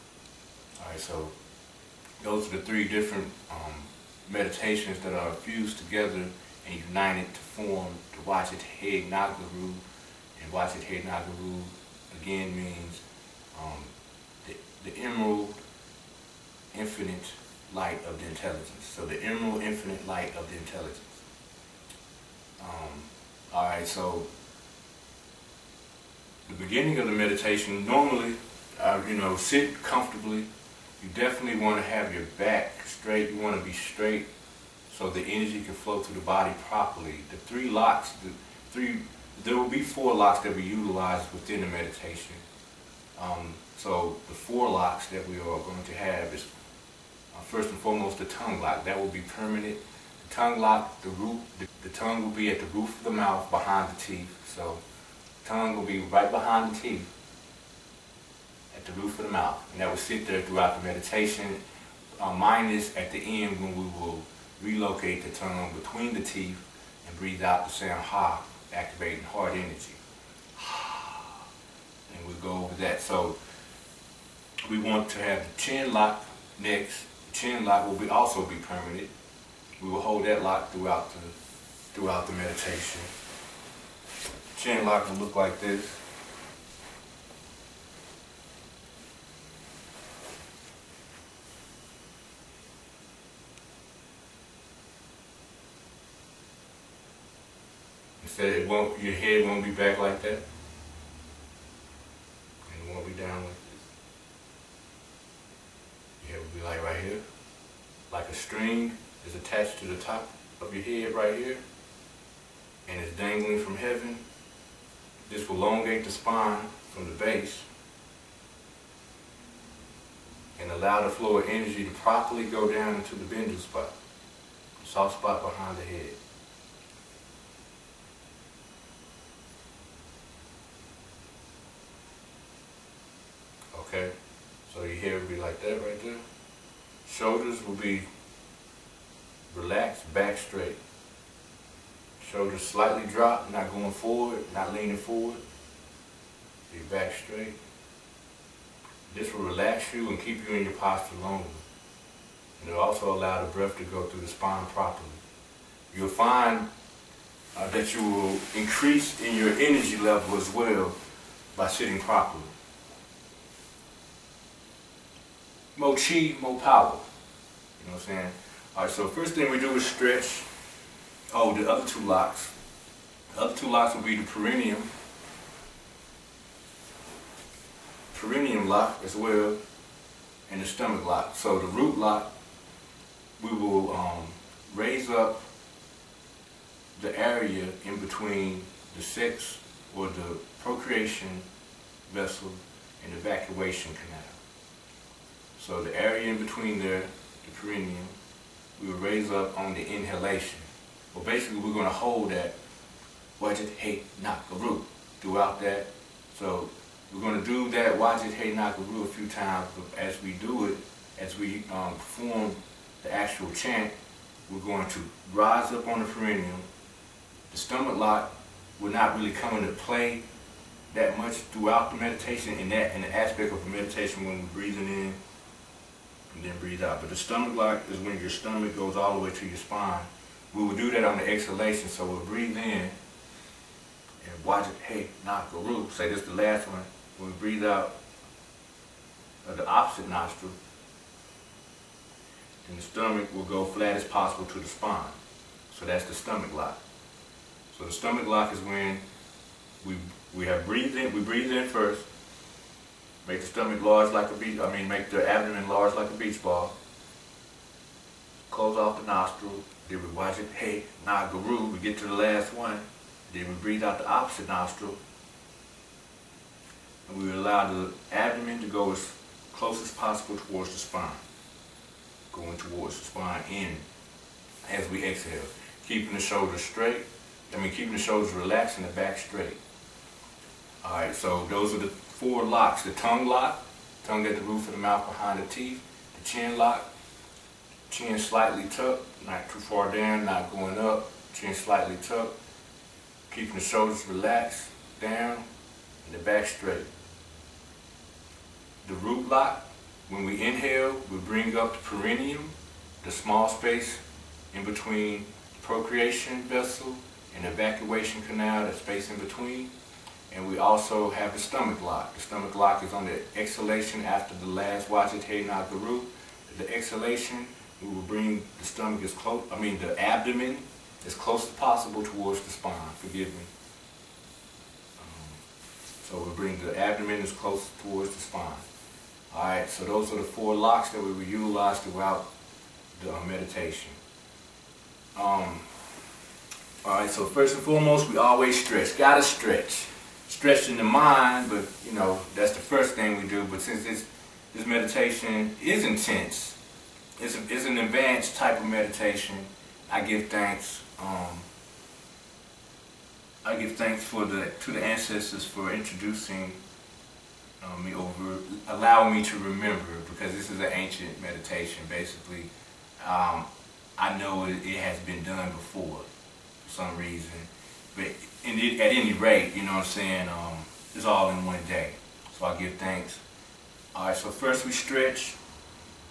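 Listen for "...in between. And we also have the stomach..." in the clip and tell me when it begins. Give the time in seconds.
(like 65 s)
309 s.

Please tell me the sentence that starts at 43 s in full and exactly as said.
Um, so the four locks that we are going to have is uh, first and foremost the tongue lock.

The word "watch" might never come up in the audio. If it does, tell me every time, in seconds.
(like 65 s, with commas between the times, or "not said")
234 s, 260 s.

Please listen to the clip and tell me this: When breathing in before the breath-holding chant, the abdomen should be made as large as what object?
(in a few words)
a beach ball.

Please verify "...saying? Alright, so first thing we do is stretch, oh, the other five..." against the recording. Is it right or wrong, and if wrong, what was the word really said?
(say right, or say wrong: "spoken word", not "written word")
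wrong: "two", not "five".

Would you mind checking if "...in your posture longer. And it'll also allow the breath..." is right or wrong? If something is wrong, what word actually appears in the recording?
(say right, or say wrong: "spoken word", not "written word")
right.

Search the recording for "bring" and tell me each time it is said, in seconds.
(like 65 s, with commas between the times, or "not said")
301 s, 318 s, 326 s.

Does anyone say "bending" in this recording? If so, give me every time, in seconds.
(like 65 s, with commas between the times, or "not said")
123 s.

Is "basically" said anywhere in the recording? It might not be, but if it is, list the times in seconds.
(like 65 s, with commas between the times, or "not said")
201 s, 361 s.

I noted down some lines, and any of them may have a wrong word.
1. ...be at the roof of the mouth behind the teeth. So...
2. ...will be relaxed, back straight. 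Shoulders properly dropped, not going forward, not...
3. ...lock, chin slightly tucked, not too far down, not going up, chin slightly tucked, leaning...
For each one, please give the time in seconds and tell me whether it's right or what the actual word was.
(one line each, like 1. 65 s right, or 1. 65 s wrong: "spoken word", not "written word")
1. 52 s right
2. 137 s wrong: "slightly", not "properly"
3. 286 s wrong: "keeping", not "leaning".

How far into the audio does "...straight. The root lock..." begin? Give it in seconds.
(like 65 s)
296 s.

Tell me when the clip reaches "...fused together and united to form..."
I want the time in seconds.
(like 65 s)
5 s.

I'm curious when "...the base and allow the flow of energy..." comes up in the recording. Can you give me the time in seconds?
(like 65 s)
117 s.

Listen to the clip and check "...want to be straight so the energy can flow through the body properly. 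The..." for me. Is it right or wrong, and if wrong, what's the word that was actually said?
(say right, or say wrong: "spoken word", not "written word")
right.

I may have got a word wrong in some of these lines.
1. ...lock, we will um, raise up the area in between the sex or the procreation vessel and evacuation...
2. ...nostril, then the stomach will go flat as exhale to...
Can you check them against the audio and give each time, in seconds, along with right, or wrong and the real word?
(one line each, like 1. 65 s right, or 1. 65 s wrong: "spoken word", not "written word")
1. 181 s right
2. 240 s wrong: "possible", not "exhale".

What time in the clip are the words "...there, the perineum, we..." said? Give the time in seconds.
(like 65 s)
196 s.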